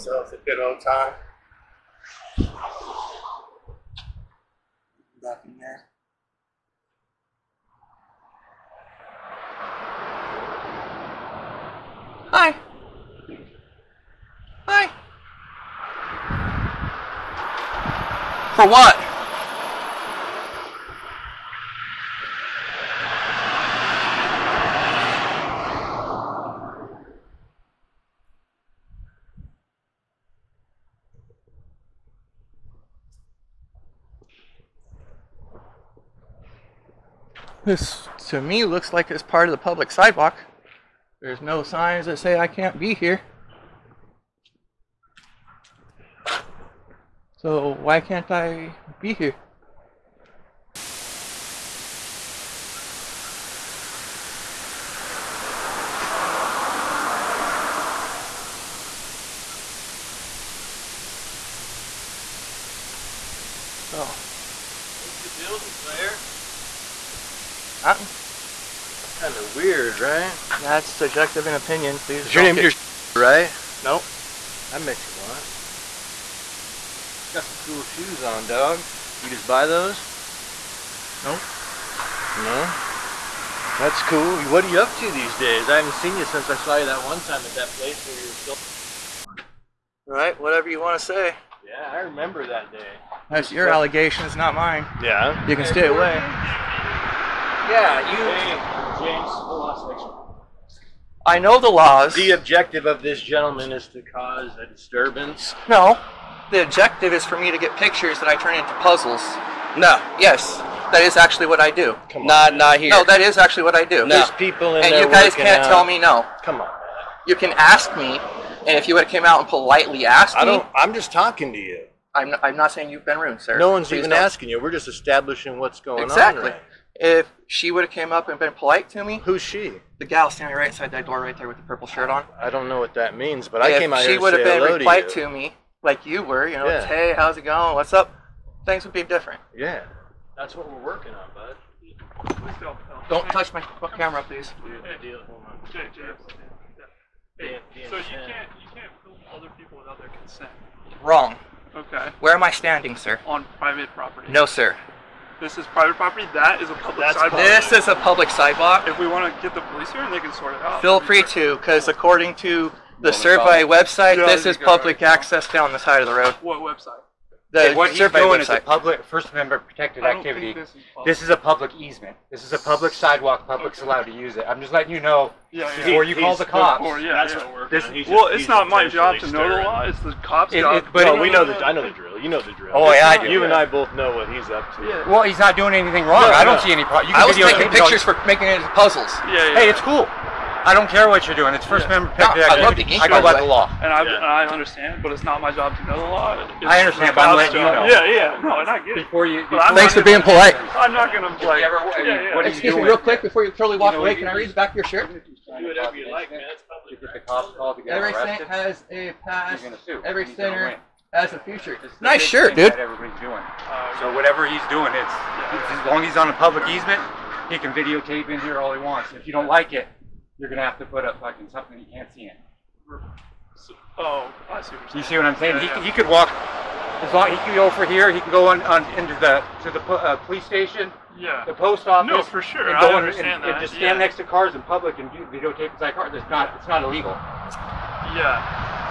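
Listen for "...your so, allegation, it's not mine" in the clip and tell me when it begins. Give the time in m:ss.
1:33.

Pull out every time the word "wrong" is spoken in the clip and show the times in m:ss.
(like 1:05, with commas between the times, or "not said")
2:31, 3:06.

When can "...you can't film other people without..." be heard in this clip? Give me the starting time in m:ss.
2:27.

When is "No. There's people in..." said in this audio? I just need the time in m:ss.
1:53.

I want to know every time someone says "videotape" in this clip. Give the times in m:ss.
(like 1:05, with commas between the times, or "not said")
3:37, 3:55.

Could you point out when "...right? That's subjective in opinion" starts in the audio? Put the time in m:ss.
1:10.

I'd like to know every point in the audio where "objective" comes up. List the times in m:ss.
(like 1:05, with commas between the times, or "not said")
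1:42, 1:46.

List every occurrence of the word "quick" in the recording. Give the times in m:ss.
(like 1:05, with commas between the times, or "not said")
3:22.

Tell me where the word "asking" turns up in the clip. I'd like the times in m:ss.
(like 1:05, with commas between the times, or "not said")
2:04.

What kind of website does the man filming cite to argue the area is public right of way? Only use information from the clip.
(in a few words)
Survey website.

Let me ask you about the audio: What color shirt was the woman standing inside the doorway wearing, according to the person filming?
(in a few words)
Purple.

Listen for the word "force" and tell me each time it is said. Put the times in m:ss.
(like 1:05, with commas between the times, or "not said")
not said.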